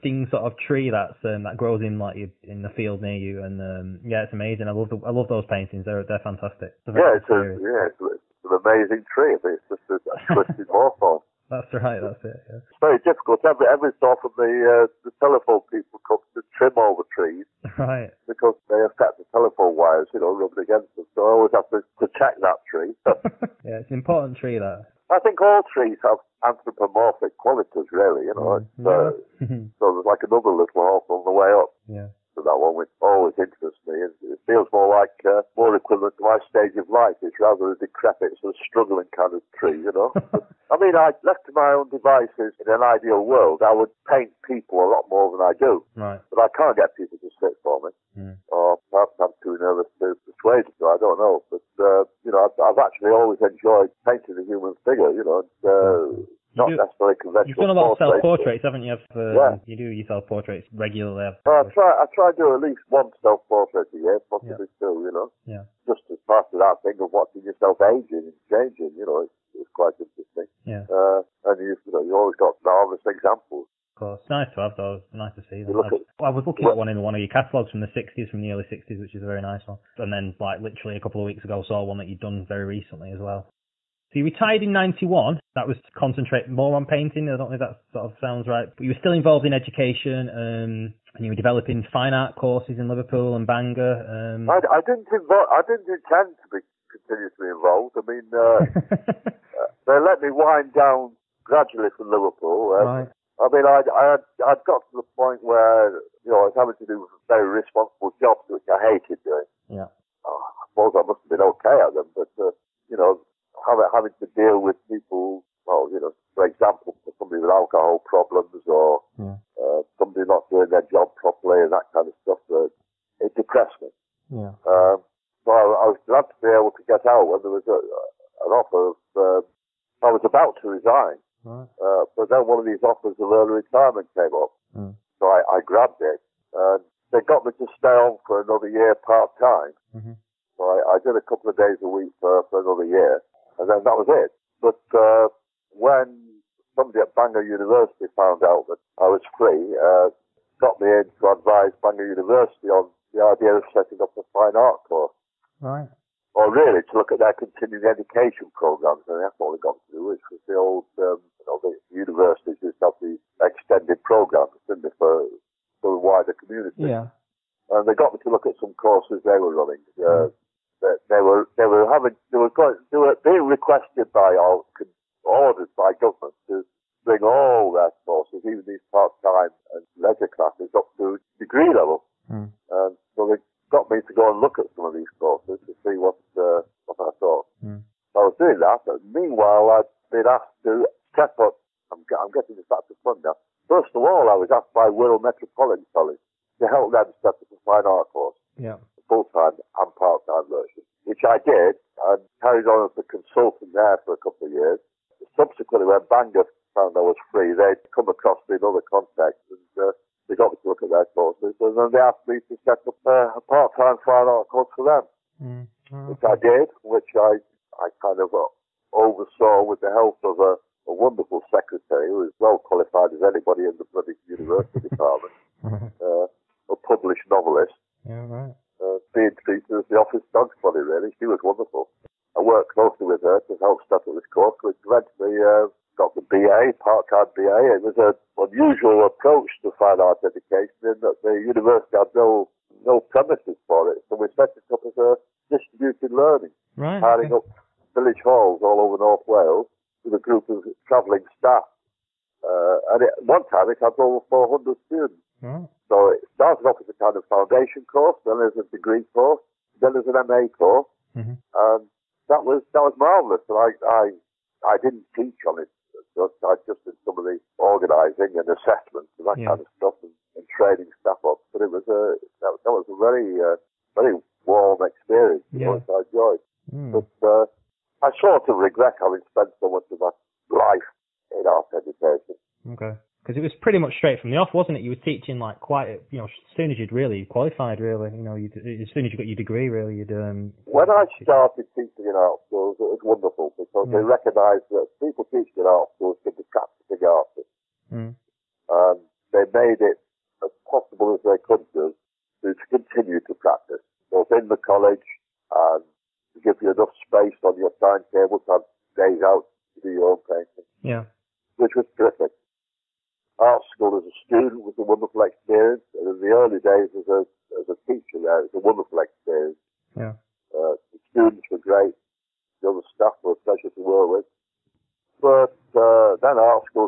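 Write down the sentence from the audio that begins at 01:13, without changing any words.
Of course, nice to have those.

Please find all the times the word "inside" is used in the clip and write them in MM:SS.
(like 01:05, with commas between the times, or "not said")
not said.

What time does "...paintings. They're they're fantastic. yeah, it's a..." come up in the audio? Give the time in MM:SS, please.
00:05.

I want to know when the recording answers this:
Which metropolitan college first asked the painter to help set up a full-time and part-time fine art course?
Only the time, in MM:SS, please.
03:14.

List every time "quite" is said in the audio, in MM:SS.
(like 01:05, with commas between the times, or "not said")
01:09, 04:45.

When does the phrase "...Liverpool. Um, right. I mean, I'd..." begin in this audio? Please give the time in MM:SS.
01:42.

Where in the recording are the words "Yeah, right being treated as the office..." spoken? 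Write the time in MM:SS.
03:48.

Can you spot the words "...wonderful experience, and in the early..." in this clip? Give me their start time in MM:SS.
05:14.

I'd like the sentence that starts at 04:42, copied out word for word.
Okay because it was pretty much straight from the off, wasn't it?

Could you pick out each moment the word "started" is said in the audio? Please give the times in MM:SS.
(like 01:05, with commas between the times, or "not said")
04:16, 04:51.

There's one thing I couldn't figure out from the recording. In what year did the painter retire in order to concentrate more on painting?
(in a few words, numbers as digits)
1991.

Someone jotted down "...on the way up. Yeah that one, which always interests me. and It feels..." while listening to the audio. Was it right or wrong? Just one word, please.
right.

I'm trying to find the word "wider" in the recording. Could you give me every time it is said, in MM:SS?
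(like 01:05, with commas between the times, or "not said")
02:46.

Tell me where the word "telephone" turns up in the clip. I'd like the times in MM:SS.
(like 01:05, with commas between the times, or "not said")
00:15, 00:19.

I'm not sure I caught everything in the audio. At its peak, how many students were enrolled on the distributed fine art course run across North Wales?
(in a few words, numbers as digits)
Over 400.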